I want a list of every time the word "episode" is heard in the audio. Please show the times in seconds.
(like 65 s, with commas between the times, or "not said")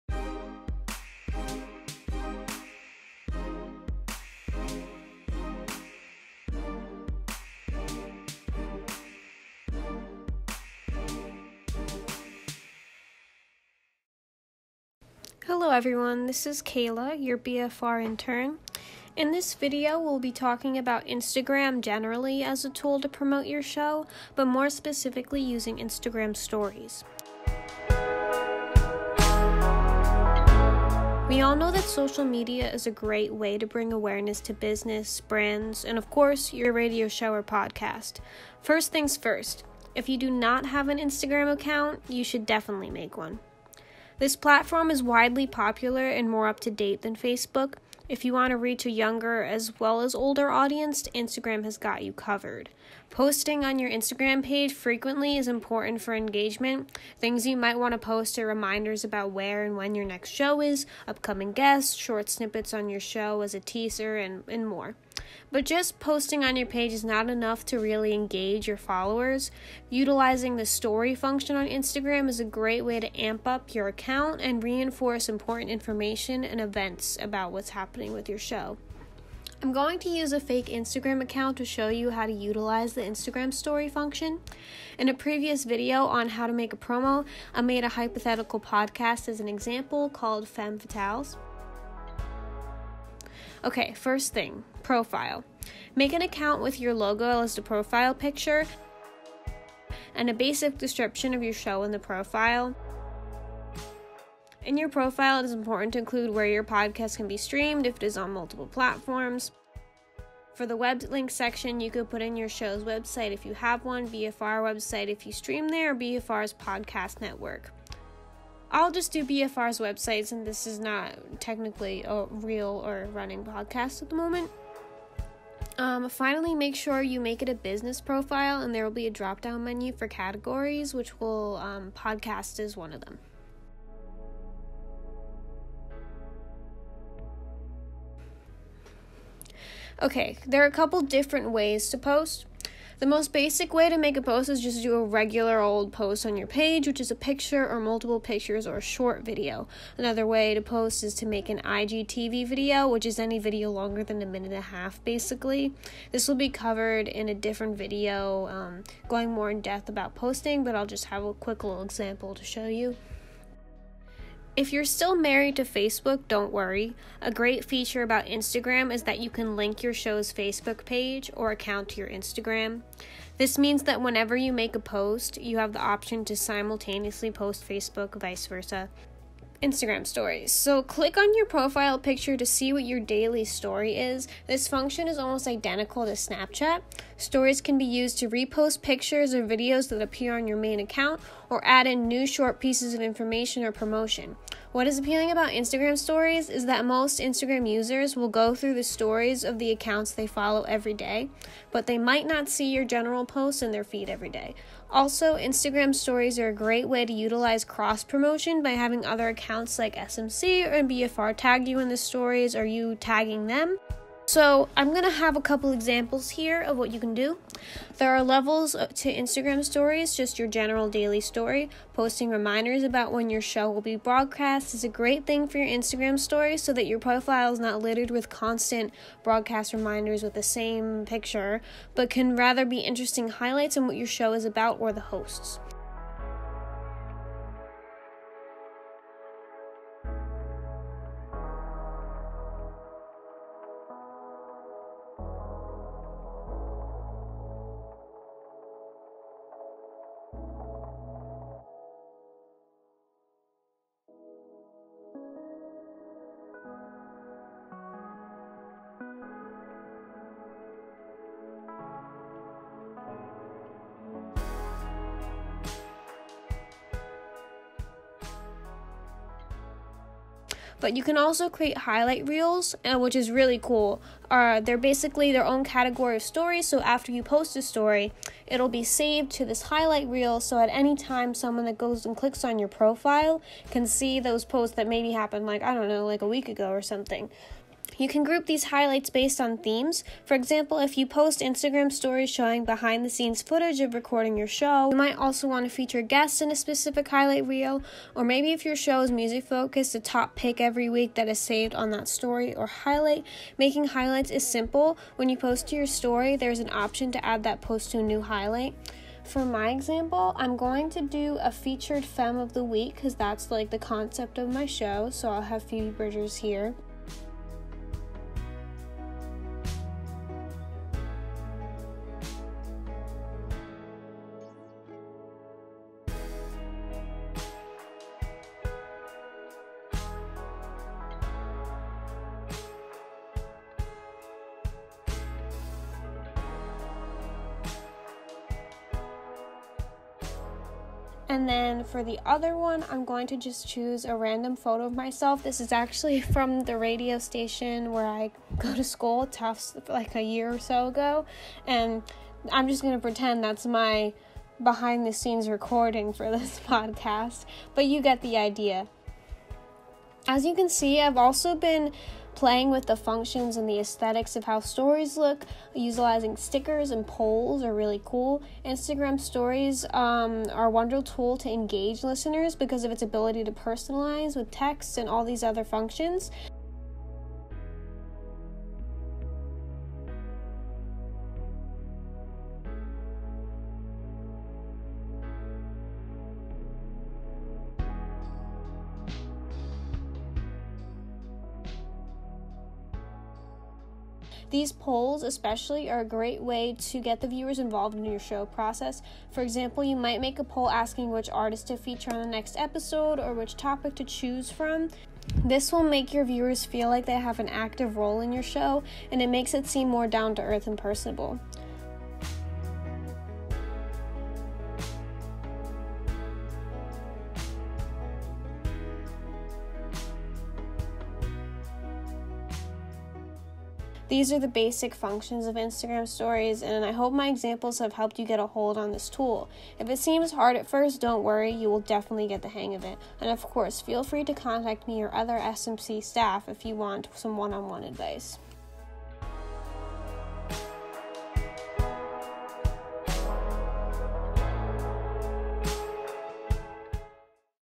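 402 s.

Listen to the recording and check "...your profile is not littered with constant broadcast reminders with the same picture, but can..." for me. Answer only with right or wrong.
right.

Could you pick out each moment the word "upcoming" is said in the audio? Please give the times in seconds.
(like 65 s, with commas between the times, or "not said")
61 s.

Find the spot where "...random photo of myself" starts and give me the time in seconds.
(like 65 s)
344 s.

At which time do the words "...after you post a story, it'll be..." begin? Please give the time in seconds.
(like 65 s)
276 s.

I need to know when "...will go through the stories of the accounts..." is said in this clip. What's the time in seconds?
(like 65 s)
198 s.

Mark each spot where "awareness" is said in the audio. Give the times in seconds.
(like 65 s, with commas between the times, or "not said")
33 s.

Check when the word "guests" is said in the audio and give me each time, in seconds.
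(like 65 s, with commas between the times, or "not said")
61 s, 296 s.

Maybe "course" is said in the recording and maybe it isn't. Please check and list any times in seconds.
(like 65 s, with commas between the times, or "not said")
36 s, 433 s.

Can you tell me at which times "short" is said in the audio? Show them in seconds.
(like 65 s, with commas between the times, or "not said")
61 s, 148 s, 192 s.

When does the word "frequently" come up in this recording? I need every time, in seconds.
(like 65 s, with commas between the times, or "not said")
54 s.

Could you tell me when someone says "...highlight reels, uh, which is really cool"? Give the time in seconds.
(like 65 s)
271 s.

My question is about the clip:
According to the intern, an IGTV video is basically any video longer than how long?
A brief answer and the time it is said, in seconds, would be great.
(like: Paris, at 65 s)
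a minute and a half, at 154 s.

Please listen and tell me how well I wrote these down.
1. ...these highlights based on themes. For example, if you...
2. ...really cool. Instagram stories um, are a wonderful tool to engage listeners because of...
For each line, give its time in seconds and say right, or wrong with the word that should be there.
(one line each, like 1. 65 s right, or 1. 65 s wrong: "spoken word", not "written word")
1. 288 s right
2. 367 s right.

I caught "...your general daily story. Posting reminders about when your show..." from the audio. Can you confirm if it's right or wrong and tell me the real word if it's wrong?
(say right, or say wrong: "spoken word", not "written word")
right.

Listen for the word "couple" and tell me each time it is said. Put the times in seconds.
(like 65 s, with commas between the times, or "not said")
140 s, 215 s.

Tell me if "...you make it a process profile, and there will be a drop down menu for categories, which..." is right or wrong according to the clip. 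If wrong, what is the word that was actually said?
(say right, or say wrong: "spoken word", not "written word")
wrong: "business", not "process".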